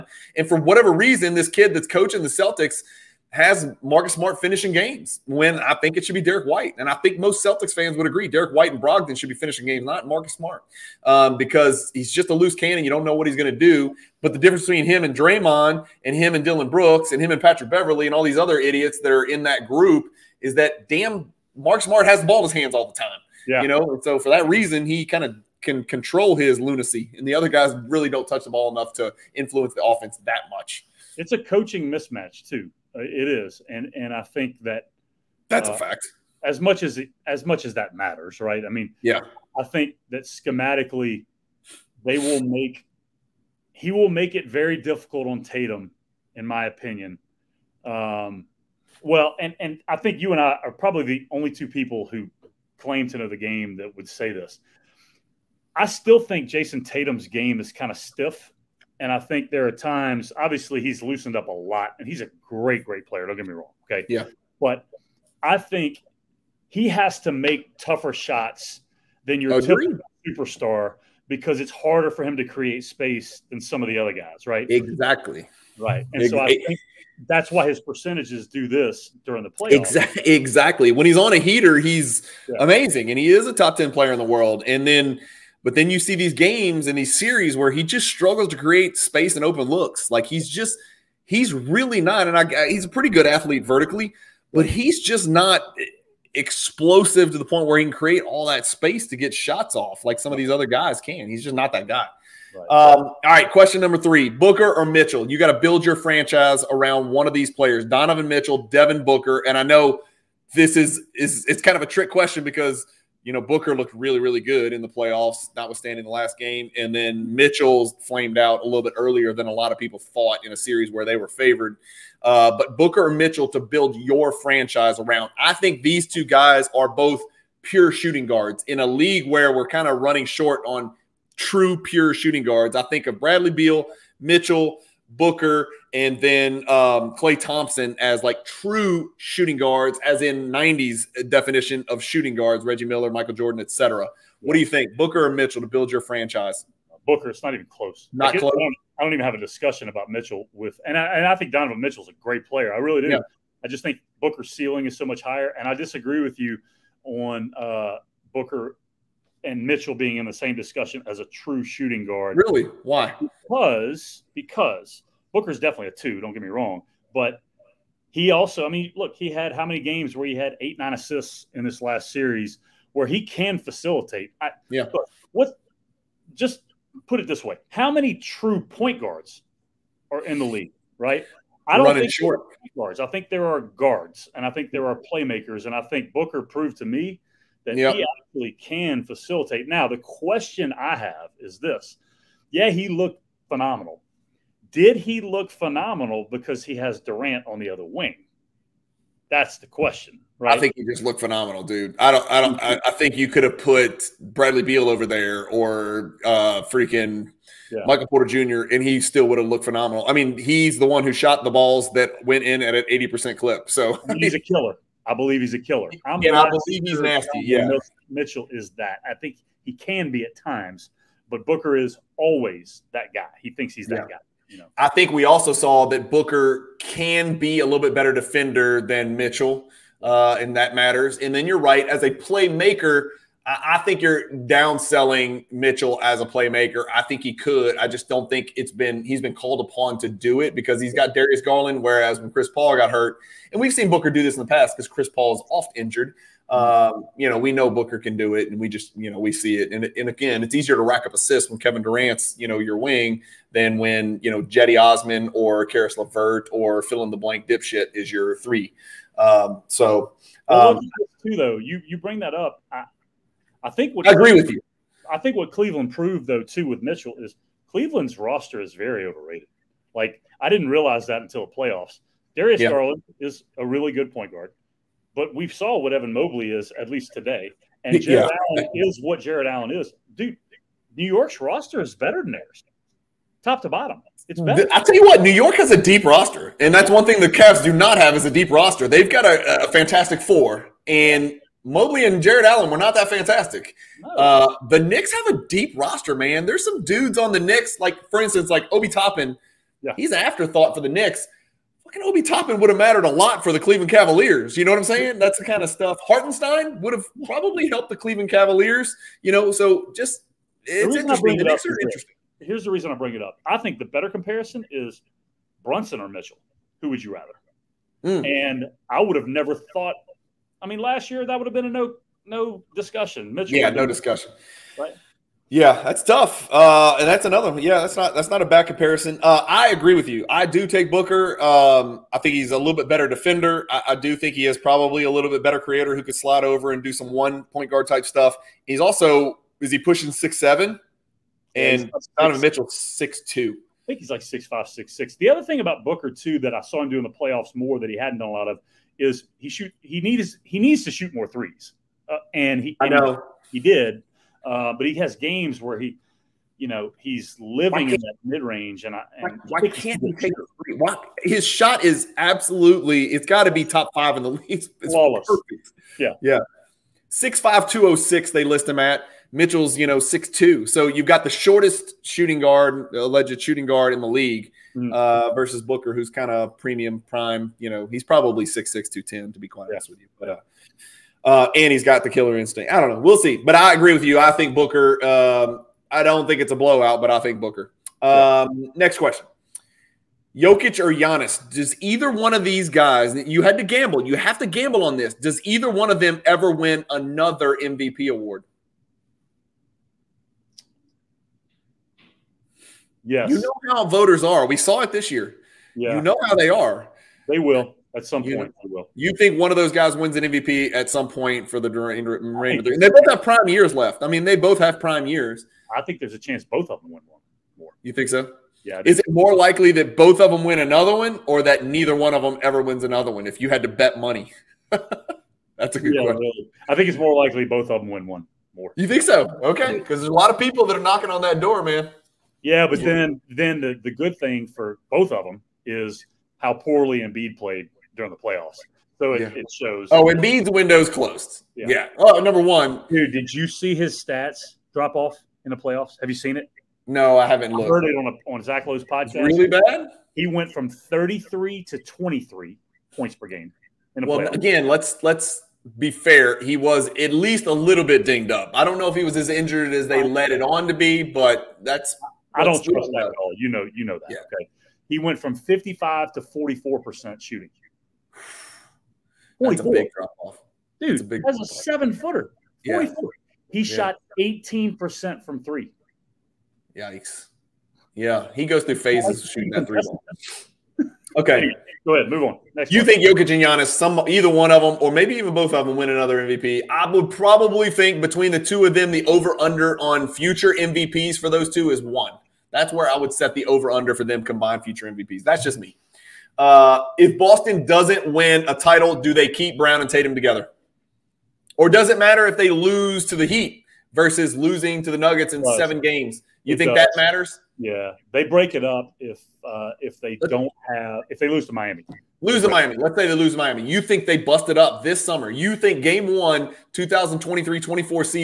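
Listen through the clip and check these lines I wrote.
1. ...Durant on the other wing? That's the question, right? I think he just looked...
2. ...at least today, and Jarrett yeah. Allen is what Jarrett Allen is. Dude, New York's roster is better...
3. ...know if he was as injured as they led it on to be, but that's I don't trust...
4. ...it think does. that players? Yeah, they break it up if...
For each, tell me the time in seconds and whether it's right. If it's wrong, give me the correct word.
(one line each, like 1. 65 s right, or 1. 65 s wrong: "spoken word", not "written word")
1. 196 s right
2. 276 s right
3. 458 s right
4. 506 s wrong: "matters", not "players".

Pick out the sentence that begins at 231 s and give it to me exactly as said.
And then you're right, as a playmaker, I, think you're downselling Mitchell as a playmaker.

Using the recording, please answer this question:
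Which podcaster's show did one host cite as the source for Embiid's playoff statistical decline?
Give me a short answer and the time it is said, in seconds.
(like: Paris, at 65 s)
Zach Lowe, at 448 s.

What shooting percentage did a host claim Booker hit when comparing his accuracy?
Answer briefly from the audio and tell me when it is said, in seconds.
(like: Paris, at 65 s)
80%, at 212 s.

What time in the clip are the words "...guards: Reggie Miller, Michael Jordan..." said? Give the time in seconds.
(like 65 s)
142 s.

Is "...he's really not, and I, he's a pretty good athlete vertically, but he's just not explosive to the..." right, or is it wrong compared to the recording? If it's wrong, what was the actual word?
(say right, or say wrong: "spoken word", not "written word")
right.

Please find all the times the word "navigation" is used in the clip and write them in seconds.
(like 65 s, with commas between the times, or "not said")
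not said.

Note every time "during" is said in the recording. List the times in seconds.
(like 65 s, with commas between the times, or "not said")
79 s, 437 s.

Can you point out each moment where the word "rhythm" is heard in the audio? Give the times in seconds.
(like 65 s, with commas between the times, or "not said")
not said.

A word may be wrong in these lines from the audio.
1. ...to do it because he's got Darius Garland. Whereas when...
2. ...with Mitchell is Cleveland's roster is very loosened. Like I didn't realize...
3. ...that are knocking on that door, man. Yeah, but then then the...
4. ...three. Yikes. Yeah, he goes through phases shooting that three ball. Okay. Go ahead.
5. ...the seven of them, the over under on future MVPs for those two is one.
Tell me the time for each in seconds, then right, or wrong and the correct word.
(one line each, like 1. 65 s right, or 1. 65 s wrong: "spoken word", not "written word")
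1. 239 s right
2. 266 s wrong: "overrated", not "loosened"
3. 430 s right
4. 475 s right
5. 488 s wrong: "two", not "seven".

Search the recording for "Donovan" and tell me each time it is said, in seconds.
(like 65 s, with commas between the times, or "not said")
107 s, 151 s, 342 s.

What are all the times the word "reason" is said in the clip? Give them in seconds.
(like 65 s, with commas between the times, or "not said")
0 s, 24 s, 312 s.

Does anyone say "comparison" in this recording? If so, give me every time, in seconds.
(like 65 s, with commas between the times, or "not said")
314 s, 328 s.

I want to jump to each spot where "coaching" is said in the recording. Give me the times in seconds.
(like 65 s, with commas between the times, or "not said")
1 s, 31 s.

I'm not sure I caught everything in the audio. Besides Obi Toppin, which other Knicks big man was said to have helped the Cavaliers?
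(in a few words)
Hartenstein.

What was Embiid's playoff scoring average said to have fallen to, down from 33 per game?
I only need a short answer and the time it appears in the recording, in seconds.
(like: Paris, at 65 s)
23 points, at 451 s.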